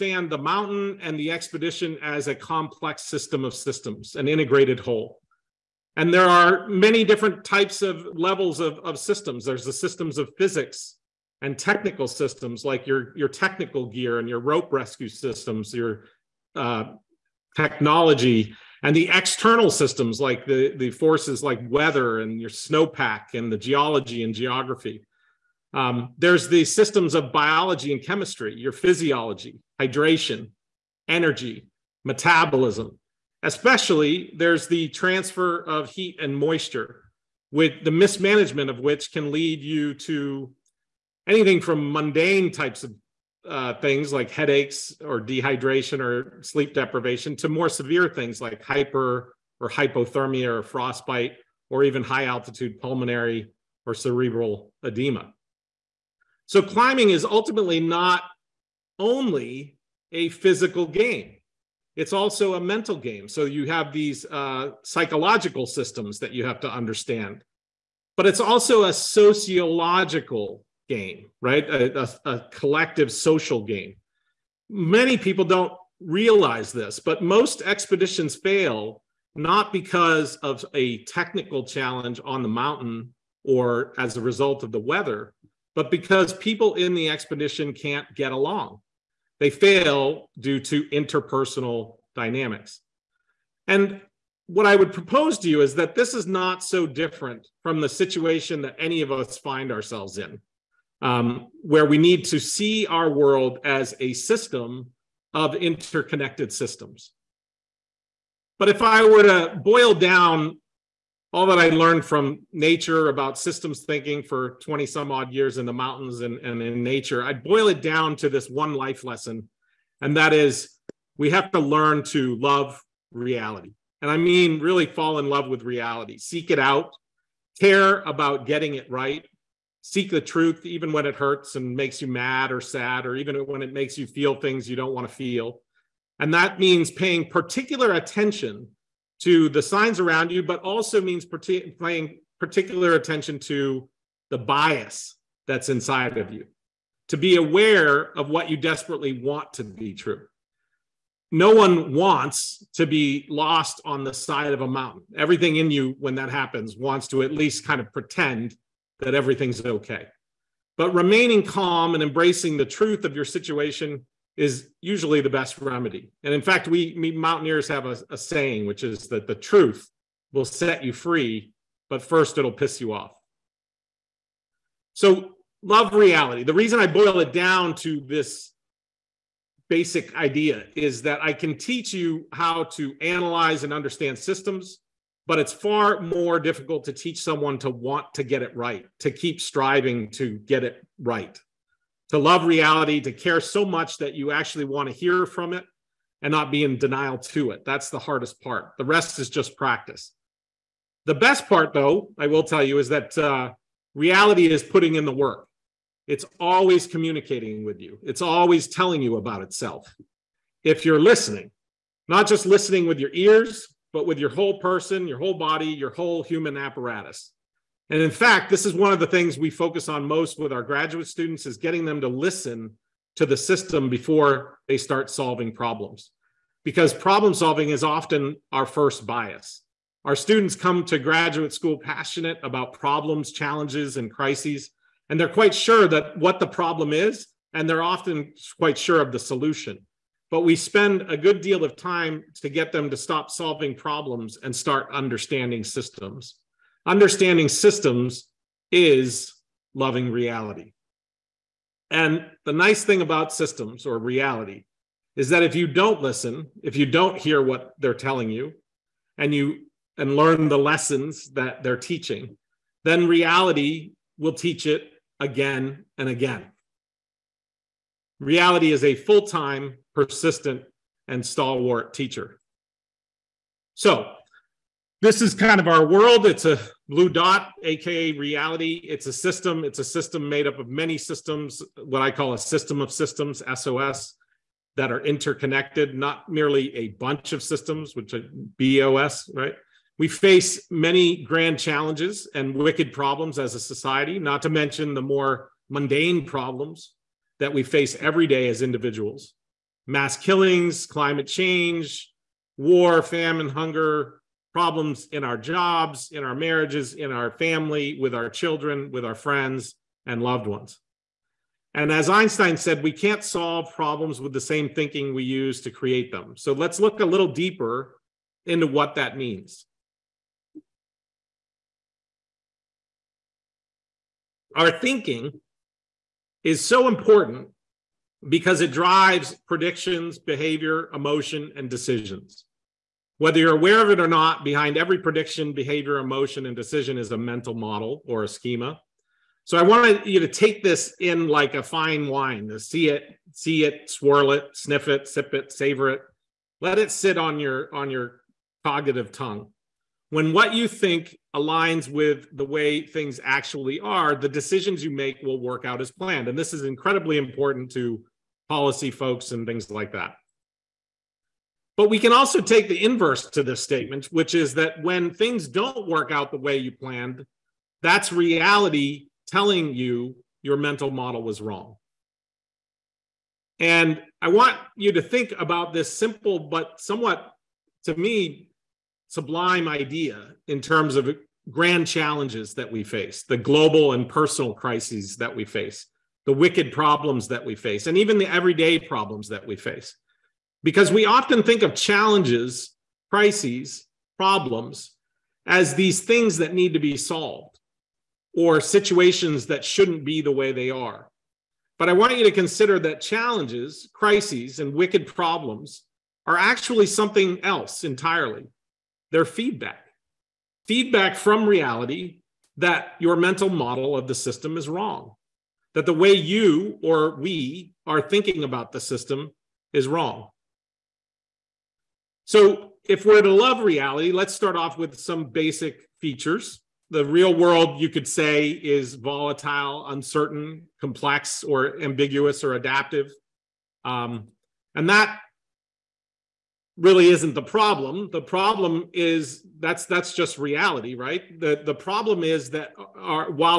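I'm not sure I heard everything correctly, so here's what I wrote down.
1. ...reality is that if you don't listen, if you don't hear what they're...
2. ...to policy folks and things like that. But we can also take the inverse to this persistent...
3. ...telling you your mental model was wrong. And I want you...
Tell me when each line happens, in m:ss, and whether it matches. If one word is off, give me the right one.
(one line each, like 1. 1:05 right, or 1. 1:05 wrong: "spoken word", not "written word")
1. 4:13 right
2. 5:57 wrong: "statement", not "persistent"
3. 6:09 right.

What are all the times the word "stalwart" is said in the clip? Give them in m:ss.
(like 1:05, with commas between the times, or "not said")
4:31.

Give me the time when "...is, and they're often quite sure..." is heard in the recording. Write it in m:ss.
3:56.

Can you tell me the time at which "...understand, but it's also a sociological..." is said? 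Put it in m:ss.
1:06.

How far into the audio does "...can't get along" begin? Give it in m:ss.
1:27.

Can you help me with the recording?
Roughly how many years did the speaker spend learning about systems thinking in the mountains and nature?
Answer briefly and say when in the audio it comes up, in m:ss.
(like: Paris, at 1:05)
20 some odd years, at 1:54.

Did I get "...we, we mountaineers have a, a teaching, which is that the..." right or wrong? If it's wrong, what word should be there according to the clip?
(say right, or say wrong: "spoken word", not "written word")
wrong: "saying", not "teaching".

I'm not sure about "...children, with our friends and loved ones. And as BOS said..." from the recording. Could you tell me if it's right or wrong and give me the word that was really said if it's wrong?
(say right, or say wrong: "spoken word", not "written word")
wrong: "Einstein", not "BOS".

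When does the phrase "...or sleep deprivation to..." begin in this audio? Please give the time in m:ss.
0:45.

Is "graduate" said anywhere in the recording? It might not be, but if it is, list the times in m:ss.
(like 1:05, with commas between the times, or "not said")
3:40, 3:50.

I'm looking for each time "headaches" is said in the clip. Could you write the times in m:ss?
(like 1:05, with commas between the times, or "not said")
0:44.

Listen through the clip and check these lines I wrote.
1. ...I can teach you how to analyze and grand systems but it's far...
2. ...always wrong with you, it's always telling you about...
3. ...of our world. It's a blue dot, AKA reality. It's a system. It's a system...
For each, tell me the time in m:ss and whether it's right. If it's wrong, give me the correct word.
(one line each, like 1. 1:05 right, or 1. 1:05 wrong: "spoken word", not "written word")
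1. 3:01 wrong: "understand", not "grand"
2. 3:26 wrong: "communicating", not "wrong"
3. 4:35 right.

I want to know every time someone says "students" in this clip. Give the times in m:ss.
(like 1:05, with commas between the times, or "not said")
3:41, 3:50.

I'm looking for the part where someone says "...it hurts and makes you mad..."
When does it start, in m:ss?
2:11.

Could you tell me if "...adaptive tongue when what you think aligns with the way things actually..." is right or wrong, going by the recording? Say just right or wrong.
wrong.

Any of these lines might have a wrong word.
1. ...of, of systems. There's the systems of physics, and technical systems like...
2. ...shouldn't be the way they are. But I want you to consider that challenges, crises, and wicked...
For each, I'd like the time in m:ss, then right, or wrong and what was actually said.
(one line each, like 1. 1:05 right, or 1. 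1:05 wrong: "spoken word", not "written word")
1. 0:08 right
2. 6:39 right.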